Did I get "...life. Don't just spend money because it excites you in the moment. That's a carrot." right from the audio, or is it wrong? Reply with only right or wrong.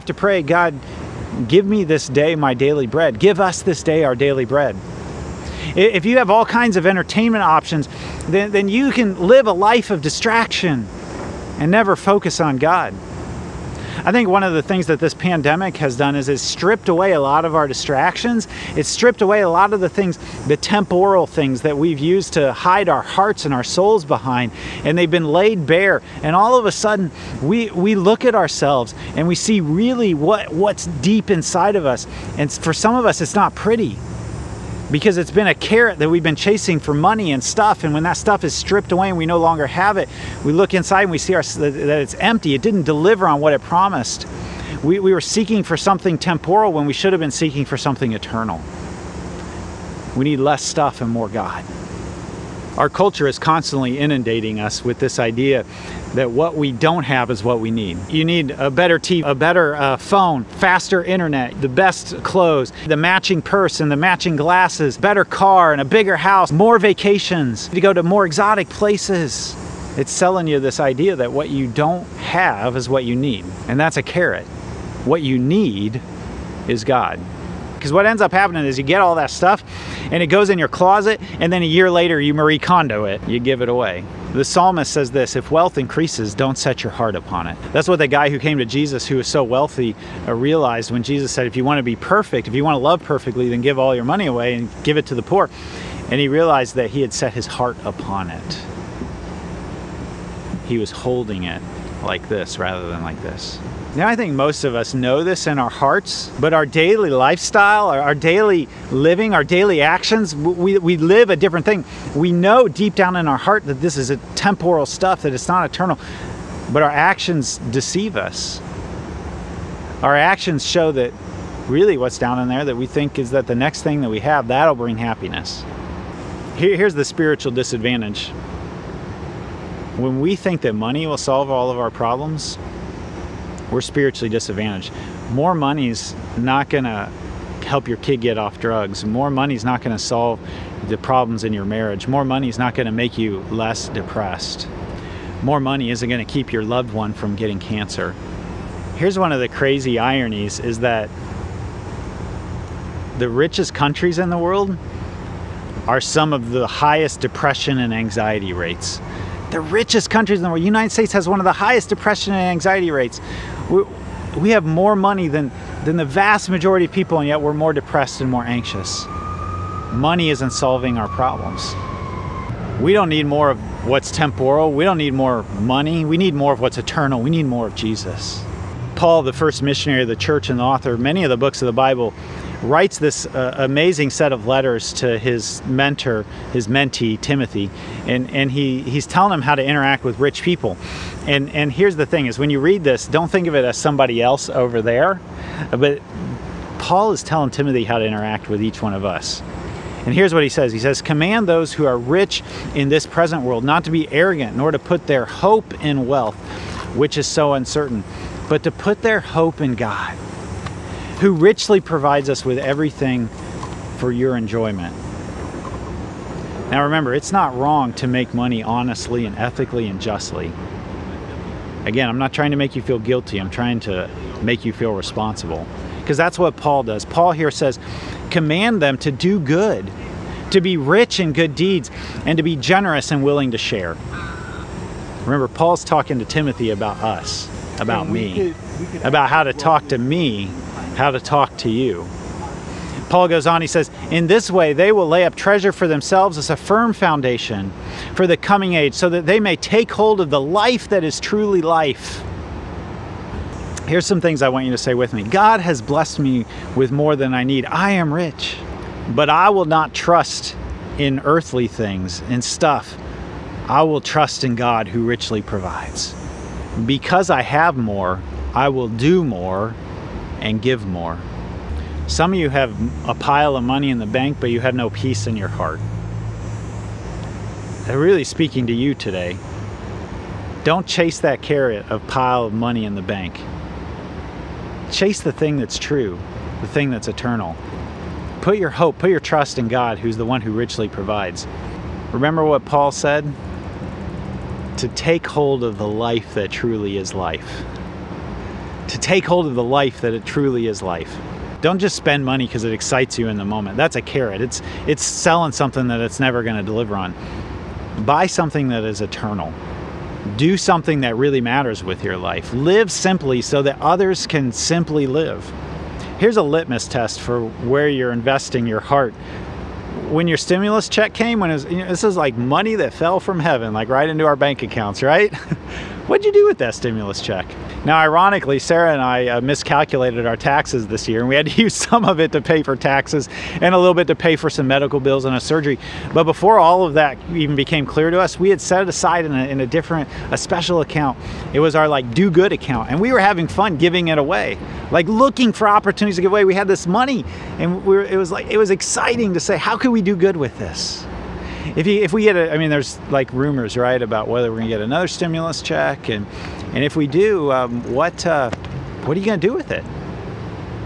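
right.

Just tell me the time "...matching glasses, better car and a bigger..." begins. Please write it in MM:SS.
01:03.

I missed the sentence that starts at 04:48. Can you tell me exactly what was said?
Put your hope, put your trust in God, who's the one who richly provides.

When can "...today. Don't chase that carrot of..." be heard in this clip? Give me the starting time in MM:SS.
04:38.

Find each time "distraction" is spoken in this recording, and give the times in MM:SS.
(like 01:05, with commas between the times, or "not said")
00:10, 00:17.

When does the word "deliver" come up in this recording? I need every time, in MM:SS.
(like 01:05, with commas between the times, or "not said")
00:42, 05:06.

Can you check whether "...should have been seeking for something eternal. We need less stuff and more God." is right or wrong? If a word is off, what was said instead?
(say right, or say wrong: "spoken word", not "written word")
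right.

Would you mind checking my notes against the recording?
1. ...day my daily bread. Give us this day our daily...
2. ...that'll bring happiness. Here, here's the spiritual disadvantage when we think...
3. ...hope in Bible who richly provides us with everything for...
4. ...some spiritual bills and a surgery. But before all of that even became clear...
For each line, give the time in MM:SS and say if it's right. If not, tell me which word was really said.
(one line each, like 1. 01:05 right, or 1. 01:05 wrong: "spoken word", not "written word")
1. 00:02 right
2. 02:04 right
3. 03:29 wrong: "God", not "Bible"
4. 05:34 wrong: "medical", not "spiritual".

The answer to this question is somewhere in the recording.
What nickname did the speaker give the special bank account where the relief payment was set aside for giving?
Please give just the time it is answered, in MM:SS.
05:42.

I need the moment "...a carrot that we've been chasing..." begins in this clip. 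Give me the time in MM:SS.
00:35.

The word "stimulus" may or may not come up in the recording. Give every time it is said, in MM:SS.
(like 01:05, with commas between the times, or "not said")
05:20, 05:26, 05:55.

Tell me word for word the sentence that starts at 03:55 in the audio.
Remember, Paul's talking to Timothy about us, about me about how to talk to me, how to talk to you.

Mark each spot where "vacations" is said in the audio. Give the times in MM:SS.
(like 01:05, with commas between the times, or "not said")
01:06.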